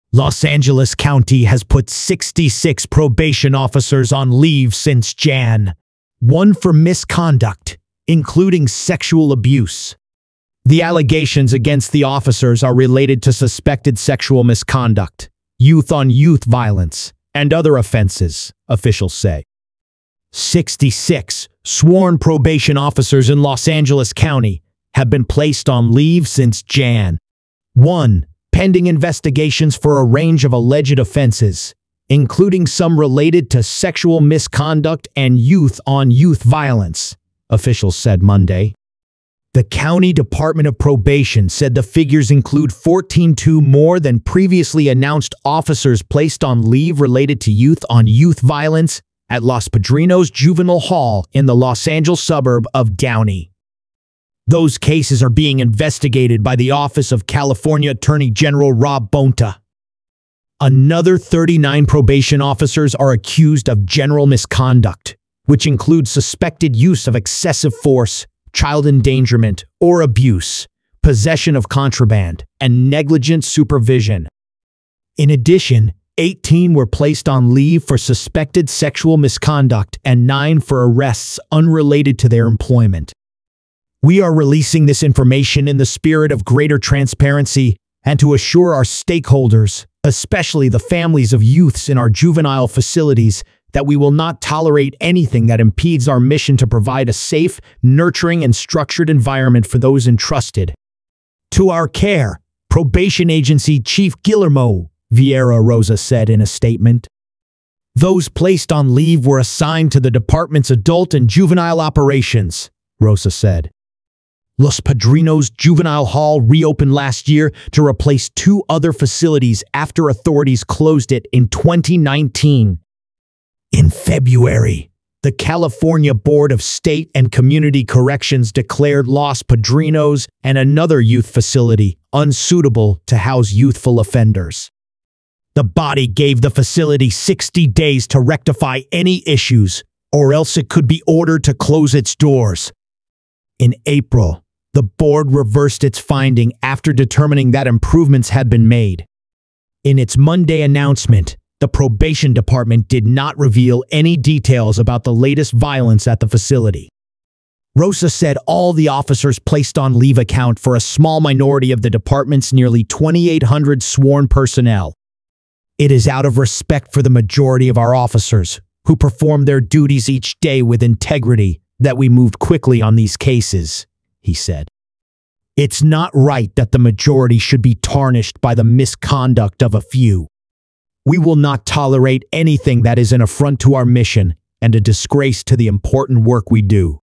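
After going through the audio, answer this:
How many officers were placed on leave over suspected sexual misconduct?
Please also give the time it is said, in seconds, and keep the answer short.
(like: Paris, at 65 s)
18, at 76 s.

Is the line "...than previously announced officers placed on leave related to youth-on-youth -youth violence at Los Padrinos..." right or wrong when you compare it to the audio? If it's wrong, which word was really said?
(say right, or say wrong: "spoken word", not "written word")
right.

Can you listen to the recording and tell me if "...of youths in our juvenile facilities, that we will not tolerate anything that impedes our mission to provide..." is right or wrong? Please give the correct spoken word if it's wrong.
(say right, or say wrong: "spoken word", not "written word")
right.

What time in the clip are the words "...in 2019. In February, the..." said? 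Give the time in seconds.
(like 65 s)
121 s.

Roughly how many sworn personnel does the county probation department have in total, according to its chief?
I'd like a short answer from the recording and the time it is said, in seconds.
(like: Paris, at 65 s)
2,800, at 162 s.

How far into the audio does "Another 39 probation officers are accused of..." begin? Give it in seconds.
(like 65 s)
60 s.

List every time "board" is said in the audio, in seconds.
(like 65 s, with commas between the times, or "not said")
126 s, 144 s.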